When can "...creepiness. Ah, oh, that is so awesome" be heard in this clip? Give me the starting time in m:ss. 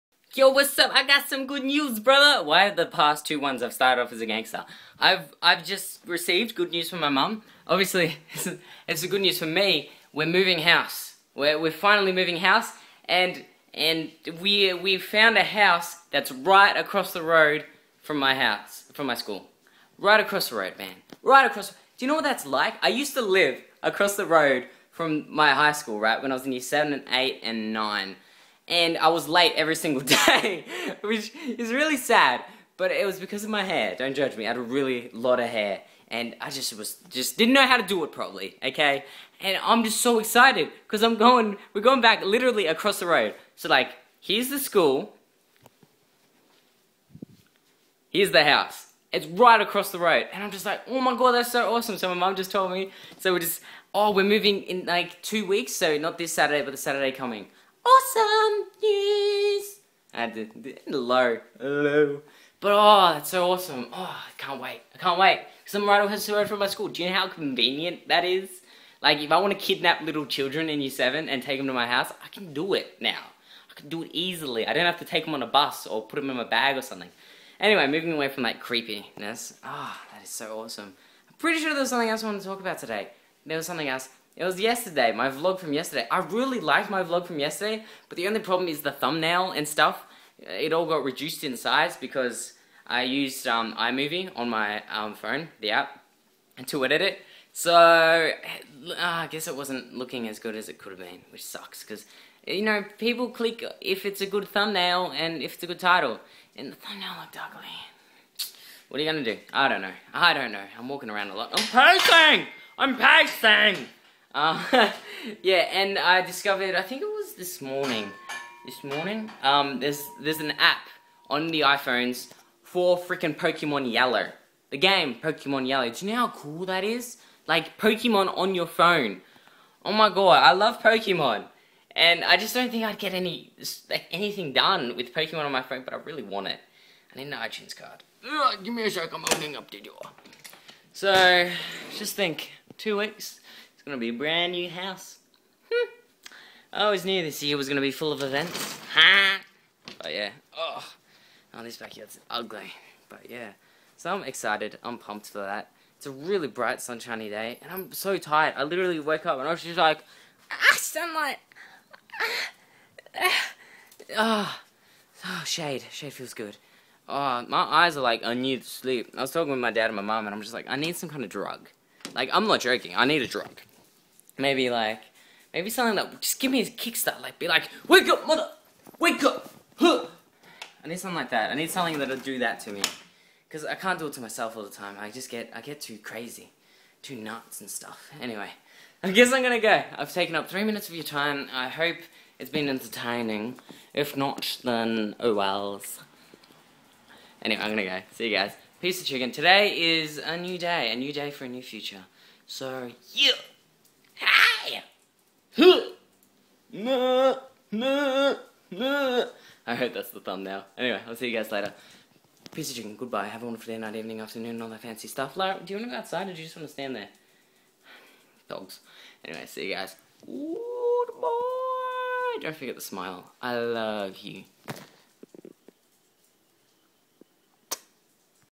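1:18.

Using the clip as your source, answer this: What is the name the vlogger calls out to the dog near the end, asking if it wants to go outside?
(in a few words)
Lara.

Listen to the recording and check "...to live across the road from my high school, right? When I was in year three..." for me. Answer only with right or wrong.
wrong.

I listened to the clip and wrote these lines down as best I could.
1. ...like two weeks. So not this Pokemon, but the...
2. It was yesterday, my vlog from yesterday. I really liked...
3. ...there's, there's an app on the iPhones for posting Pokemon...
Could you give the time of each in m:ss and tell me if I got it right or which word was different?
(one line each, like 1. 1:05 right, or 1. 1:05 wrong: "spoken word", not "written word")
1. 0:54 wrong: "Saturday", not "Pokemon"
2. 1:24 right
3. 1:59 wrong: "freaking", not "posting".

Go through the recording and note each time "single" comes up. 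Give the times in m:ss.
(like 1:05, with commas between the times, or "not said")
0:29.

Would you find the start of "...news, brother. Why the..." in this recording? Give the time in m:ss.
0:01.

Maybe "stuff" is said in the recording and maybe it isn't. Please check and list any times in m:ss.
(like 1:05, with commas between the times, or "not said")
1:29, 3:07, 3:35.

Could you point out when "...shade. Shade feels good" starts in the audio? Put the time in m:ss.
2:45.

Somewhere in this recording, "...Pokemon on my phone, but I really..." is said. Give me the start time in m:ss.
2:15.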